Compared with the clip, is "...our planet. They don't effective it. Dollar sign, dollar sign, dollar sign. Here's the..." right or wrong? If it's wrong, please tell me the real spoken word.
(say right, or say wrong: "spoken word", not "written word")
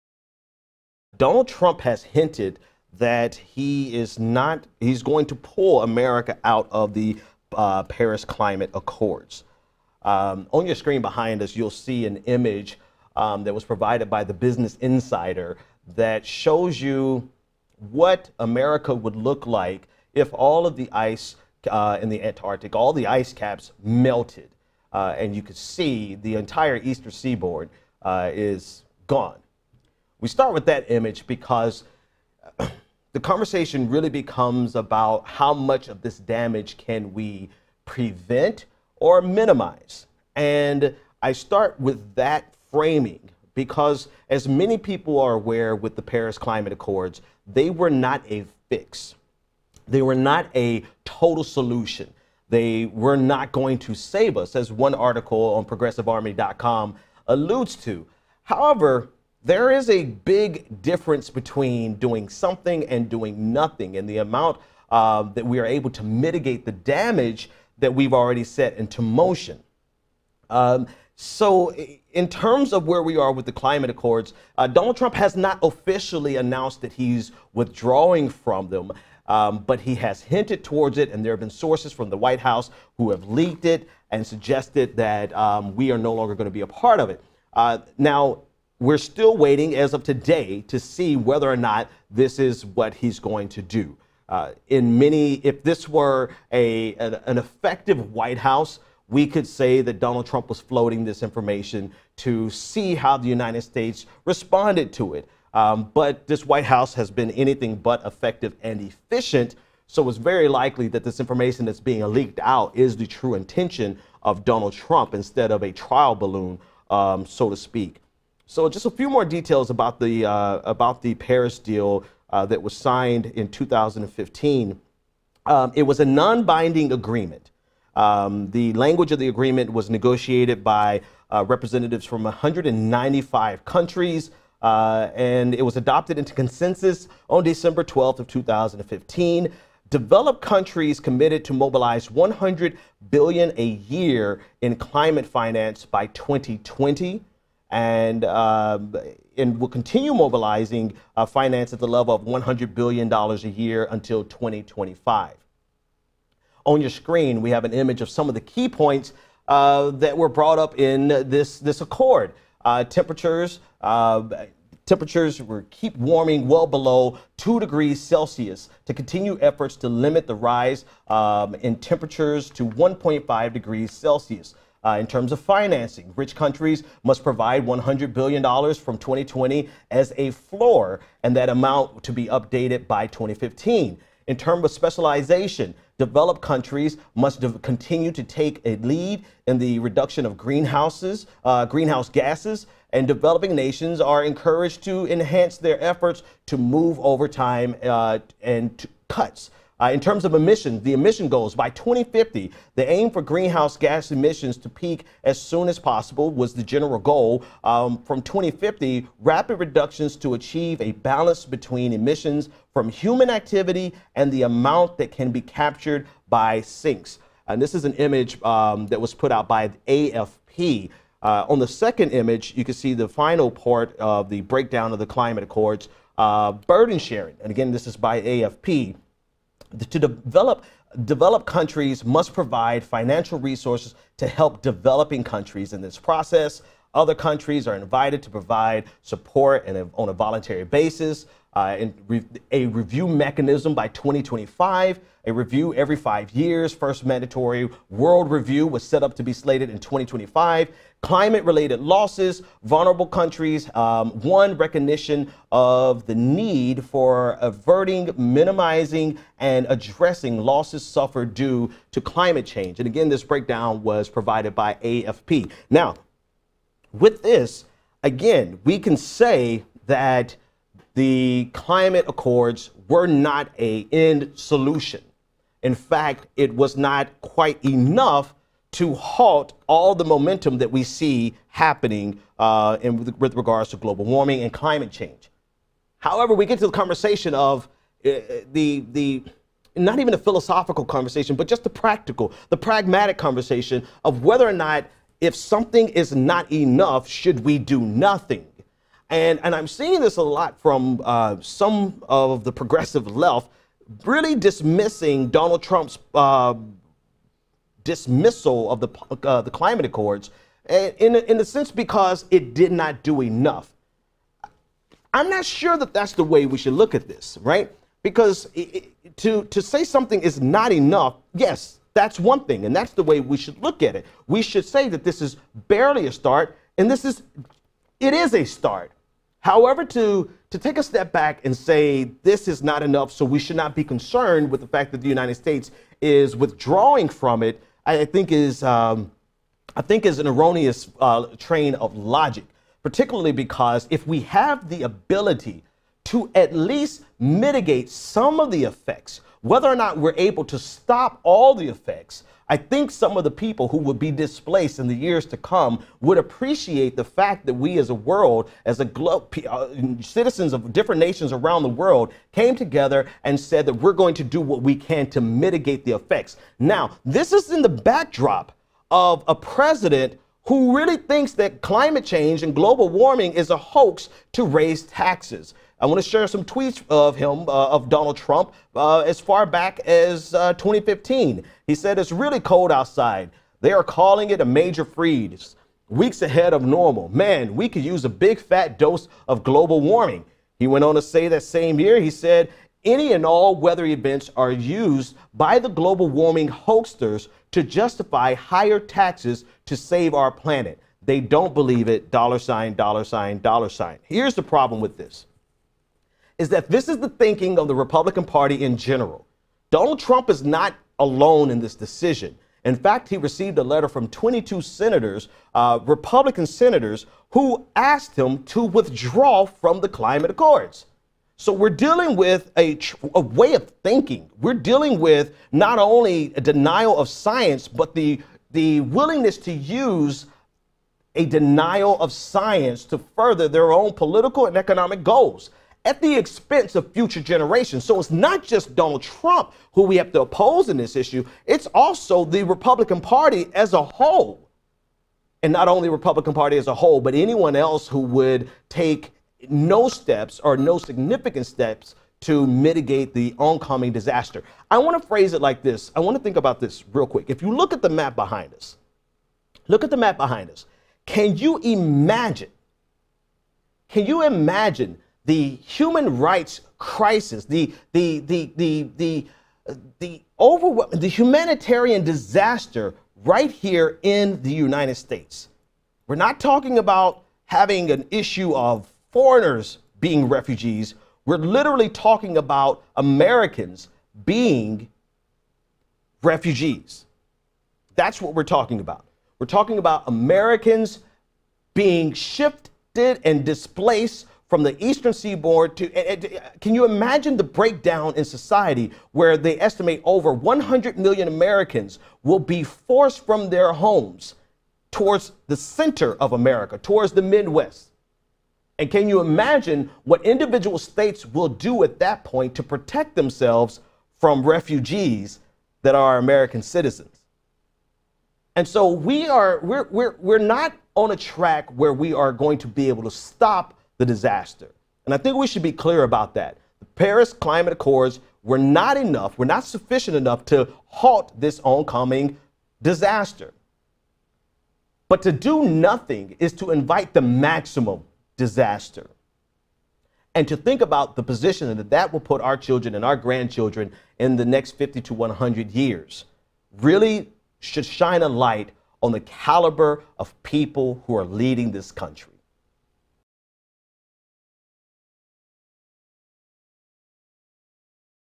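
wrong: "believe", not "effective".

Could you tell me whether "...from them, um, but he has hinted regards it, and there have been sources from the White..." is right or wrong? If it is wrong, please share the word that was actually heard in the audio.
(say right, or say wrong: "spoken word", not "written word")
wrong: "towards", not "regards".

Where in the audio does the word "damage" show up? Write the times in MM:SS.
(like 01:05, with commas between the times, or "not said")
00:36, 01:06.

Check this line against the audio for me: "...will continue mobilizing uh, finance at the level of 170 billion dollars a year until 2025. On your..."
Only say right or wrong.
wrong.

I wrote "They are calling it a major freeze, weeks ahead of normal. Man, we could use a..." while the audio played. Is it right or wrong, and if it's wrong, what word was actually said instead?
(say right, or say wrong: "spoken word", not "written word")
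right.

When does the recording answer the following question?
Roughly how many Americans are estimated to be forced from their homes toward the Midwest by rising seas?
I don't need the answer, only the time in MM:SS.
08:20.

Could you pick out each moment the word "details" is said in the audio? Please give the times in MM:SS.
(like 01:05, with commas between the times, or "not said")
01:59.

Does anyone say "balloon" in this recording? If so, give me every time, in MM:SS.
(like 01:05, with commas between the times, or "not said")
01:56.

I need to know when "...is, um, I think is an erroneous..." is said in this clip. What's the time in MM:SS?
05:38.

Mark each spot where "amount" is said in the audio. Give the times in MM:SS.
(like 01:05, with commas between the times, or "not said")
01:04, 03:01, 03:34.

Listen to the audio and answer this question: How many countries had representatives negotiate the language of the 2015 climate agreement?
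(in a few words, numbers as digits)
195.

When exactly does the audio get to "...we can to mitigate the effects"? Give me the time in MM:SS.
06:04.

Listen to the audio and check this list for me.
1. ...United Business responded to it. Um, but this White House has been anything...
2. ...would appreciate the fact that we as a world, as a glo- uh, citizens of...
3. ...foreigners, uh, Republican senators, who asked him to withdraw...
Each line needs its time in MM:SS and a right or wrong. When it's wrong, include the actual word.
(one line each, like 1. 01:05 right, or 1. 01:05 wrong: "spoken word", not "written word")
1. 01:43 wrong: "States", not "Business"
2. 05:56 right
3. 06:54 wrong: "senators", not "foreigners".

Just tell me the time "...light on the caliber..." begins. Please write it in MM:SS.
09:08.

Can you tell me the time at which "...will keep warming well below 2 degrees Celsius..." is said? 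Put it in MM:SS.
02:45.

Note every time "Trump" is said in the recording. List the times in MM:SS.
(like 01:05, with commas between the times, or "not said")
00:01, 01:14, 01:40, 01:54, 05:05, 06:18, 06:49, 07:19.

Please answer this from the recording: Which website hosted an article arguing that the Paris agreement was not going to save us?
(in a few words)
progressivearmy.com.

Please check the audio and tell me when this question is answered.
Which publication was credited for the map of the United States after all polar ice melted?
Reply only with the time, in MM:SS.
00:14.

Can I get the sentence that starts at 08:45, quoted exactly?
And I think we should be clear about that.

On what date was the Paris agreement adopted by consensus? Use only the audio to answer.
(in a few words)
December 12th, 2015.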